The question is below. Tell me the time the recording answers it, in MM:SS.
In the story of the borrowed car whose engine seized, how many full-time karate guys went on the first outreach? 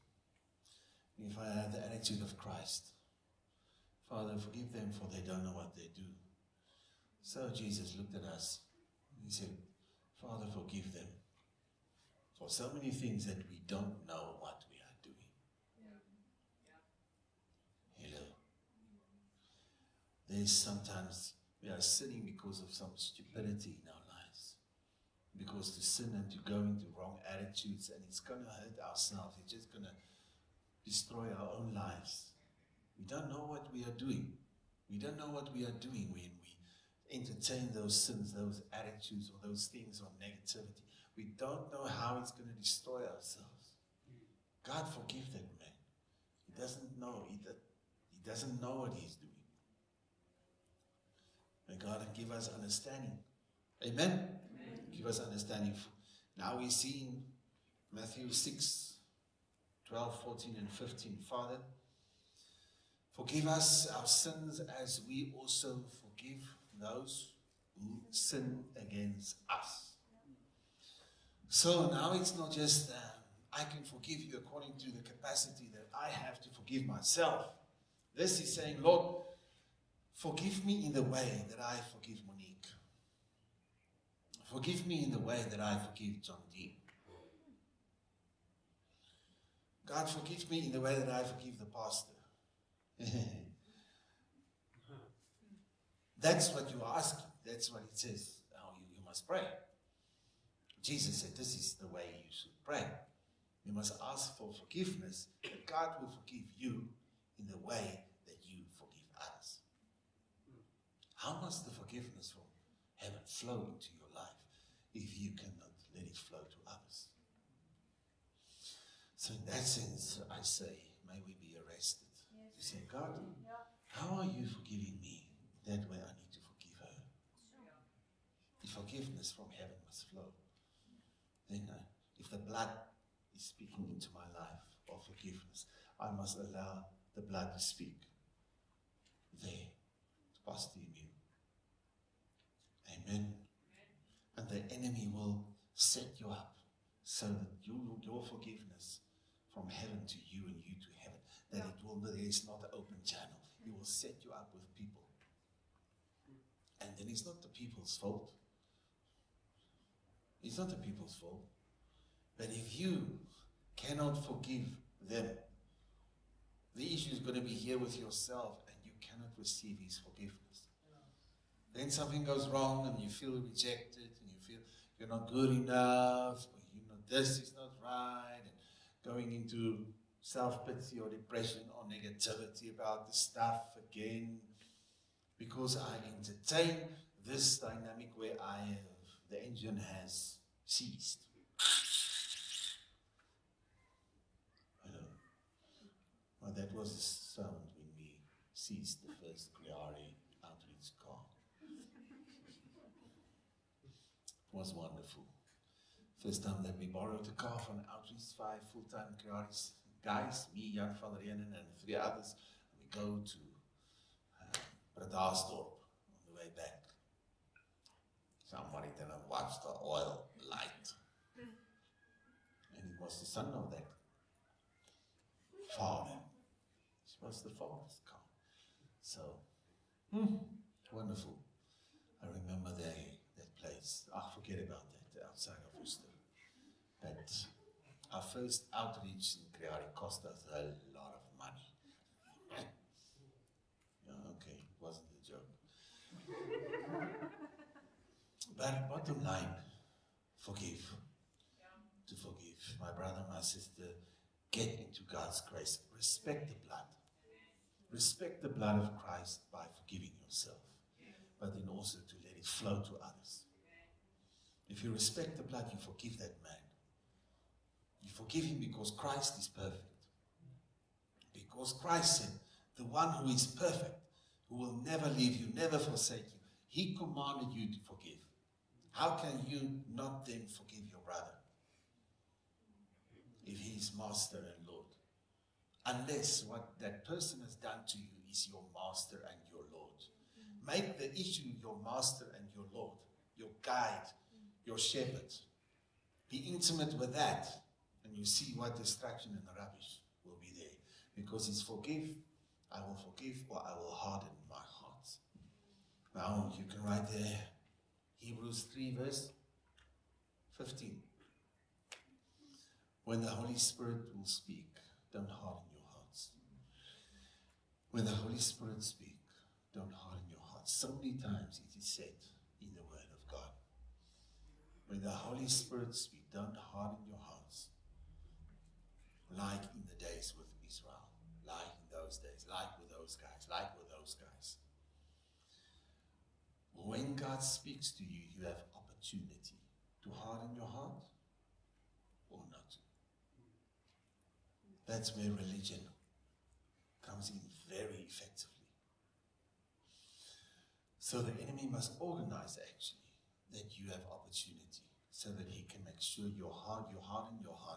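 03:28.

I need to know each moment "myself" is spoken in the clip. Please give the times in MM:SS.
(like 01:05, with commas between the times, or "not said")
01:16.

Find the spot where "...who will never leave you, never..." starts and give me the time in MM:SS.
04:34.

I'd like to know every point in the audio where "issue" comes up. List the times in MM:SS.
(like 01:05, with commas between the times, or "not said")
02:46, 04:51.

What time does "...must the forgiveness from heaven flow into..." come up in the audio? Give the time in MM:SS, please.
01:51.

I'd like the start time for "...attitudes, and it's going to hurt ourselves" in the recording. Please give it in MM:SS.
00:27.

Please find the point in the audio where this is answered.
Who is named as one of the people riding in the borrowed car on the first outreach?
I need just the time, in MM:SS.
03:30.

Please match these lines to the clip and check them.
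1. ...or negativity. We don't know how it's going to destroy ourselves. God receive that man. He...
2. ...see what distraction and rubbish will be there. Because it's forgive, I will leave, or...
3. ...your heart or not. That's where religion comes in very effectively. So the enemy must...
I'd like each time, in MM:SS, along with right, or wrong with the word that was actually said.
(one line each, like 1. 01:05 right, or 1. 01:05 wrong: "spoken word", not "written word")
1. 00:40 wrong: "forgive", not "receive"
2. 04:58 wrong: "forgive", not "leave"
3. 05:40 right.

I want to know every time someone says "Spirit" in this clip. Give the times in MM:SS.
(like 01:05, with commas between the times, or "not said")
05:13, 05:18, 05:25.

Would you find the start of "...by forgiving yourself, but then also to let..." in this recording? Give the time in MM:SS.
04:19.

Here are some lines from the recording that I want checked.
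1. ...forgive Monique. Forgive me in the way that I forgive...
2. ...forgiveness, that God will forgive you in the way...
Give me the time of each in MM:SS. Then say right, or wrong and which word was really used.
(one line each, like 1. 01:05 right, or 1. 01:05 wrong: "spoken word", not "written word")
1. 01:21 right
2. 01:44 right.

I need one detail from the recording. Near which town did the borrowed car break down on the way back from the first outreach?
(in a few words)
Worcester.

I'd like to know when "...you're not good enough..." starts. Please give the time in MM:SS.
02:54.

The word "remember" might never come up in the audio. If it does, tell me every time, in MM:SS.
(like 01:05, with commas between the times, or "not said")
03:52.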